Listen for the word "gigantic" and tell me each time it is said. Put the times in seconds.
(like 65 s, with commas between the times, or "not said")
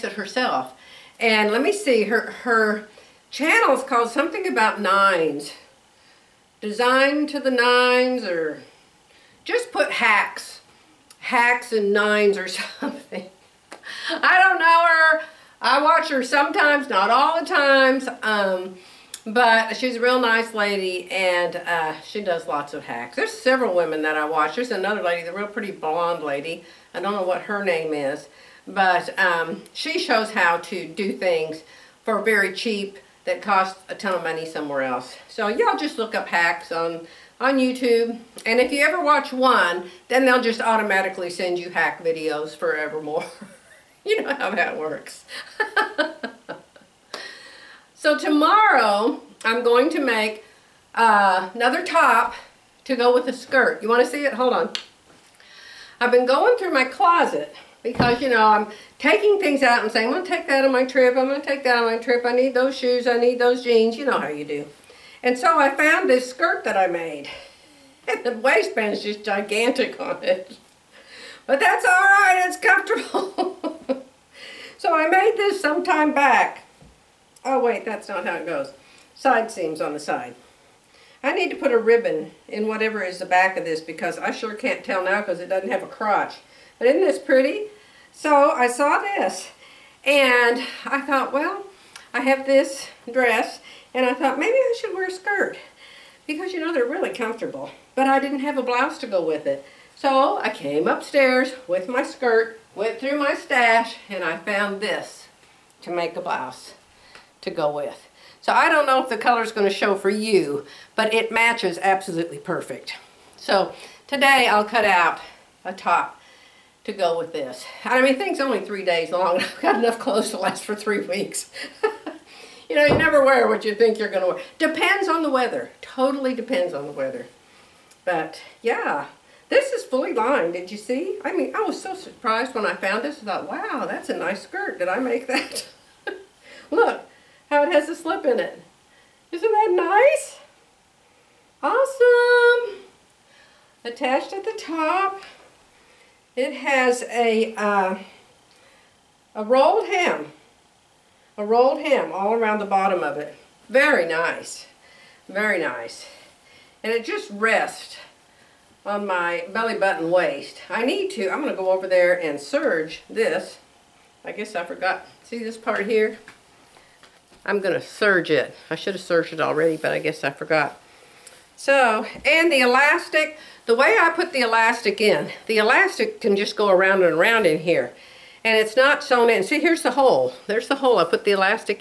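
69 s.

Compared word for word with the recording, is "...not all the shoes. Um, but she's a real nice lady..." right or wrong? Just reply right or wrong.
wrong.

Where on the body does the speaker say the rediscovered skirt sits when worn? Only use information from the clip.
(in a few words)
belly button waist.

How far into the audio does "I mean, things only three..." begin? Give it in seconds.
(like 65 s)
117 s.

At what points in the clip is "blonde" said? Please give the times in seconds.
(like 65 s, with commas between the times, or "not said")
25 s.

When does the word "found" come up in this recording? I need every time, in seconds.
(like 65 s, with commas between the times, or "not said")
65 s, 104 s, 132 s.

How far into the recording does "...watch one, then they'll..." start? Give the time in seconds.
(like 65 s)
39 s.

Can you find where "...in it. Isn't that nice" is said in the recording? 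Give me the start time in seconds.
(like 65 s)
138 s.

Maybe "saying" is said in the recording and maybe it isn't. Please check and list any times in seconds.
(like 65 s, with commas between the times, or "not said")
59 s.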